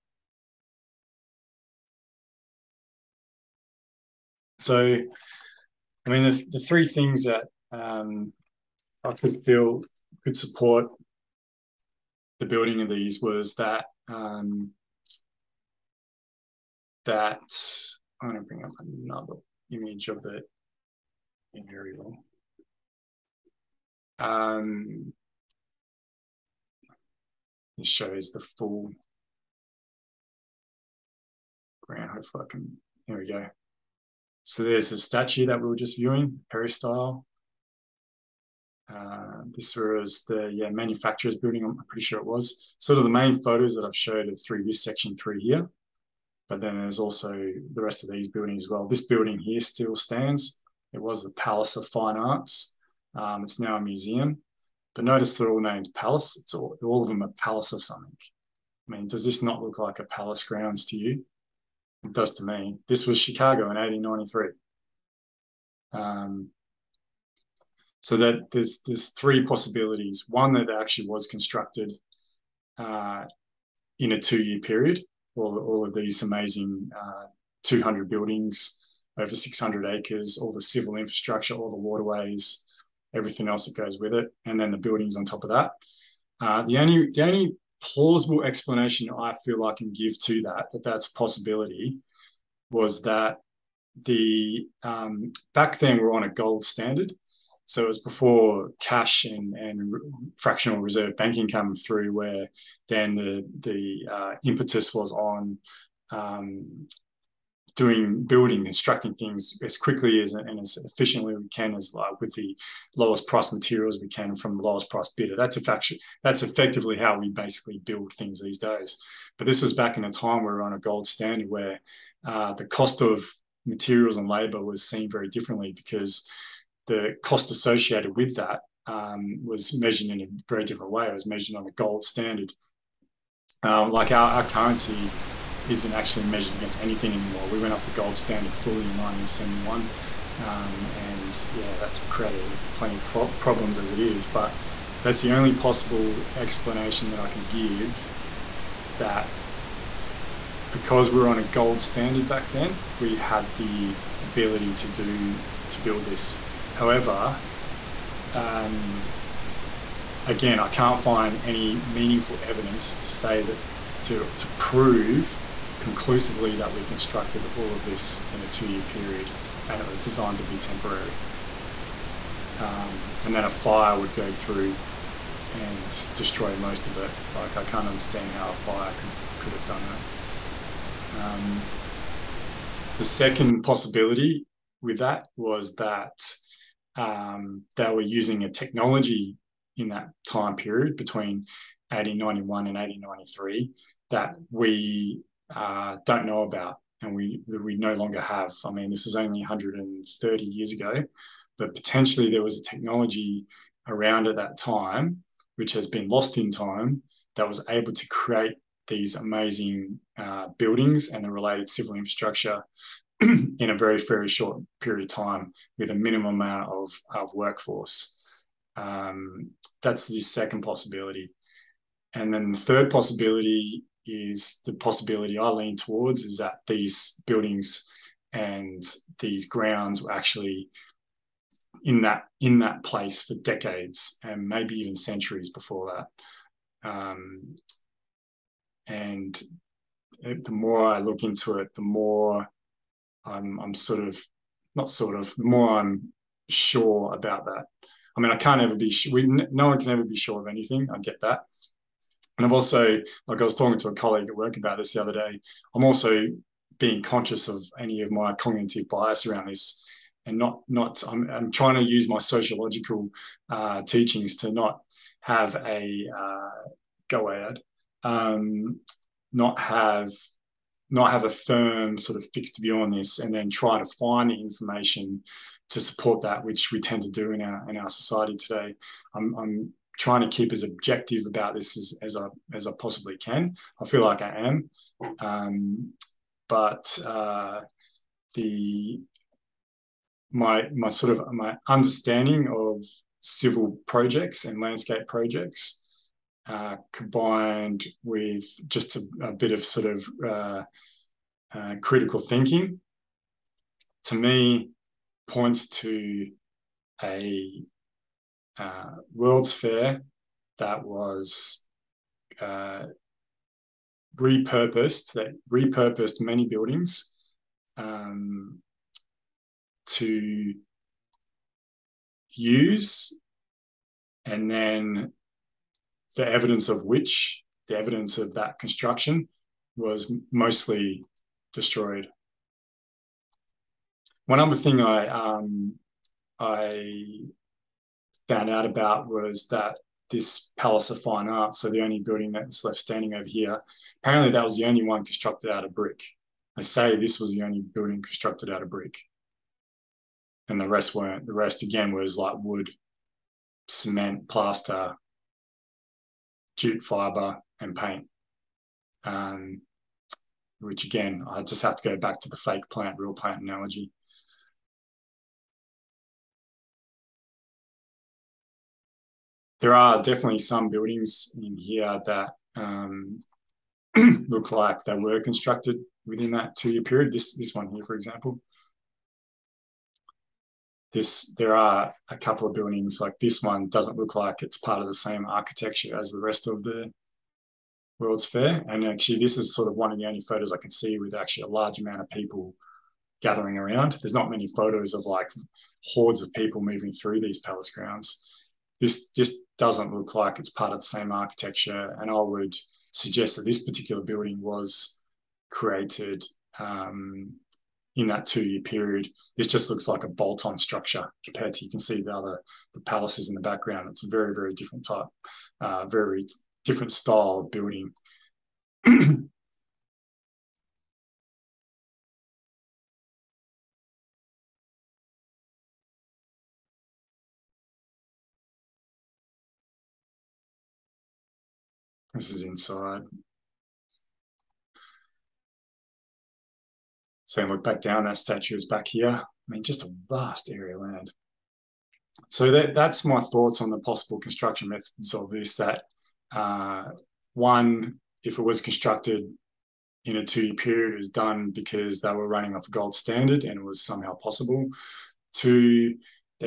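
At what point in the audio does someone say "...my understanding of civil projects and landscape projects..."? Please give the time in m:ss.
4:51.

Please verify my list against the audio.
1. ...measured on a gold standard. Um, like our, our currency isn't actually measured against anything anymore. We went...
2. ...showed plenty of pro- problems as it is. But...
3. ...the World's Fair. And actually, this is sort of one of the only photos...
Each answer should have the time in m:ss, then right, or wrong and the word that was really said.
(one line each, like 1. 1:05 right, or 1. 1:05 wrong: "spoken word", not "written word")
1. 2:11 right
2. 2:22 wrong: "created", not "showed"
3. 6:26 right.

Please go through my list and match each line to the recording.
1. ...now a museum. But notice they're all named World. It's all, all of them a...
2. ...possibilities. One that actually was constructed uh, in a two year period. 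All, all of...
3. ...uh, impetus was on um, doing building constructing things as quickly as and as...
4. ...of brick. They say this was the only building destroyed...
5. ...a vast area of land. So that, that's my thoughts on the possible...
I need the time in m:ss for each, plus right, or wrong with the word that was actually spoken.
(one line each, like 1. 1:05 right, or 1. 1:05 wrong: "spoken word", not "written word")
1. 0:53 wrong: "Palace", not "World"
2. 1:09 right
3. 1:44 right
4. 5:45 wrong: "constructed", not "destroyed"
5. 7:19 right.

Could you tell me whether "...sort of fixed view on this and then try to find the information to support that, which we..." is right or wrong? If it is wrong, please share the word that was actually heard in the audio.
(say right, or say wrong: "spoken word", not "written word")
right.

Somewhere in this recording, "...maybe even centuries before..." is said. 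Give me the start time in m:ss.
3:54.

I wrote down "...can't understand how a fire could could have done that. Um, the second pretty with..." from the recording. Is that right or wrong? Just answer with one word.
wrong.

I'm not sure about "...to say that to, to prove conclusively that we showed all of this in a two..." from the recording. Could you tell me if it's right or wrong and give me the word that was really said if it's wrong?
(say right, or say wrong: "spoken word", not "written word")
wrong: "constructed", not "showed".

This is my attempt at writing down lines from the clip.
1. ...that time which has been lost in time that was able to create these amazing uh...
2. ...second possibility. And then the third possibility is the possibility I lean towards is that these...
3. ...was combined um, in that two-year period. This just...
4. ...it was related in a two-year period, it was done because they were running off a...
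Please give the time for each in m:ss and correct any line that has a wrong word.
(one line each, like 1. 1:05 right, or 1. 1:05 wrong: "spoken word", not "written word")
1. 3:24 right
2. 3:40 right
3. 6:44 wrong: "created", not "combined"
4. 7:28 wrong: "constructed", not "related".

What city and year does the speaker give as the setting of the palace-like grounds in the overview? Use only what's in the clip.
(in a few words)
Chicago in 1893.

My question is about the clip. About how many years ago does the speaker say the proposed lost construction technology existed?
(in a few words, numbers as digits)
130 years.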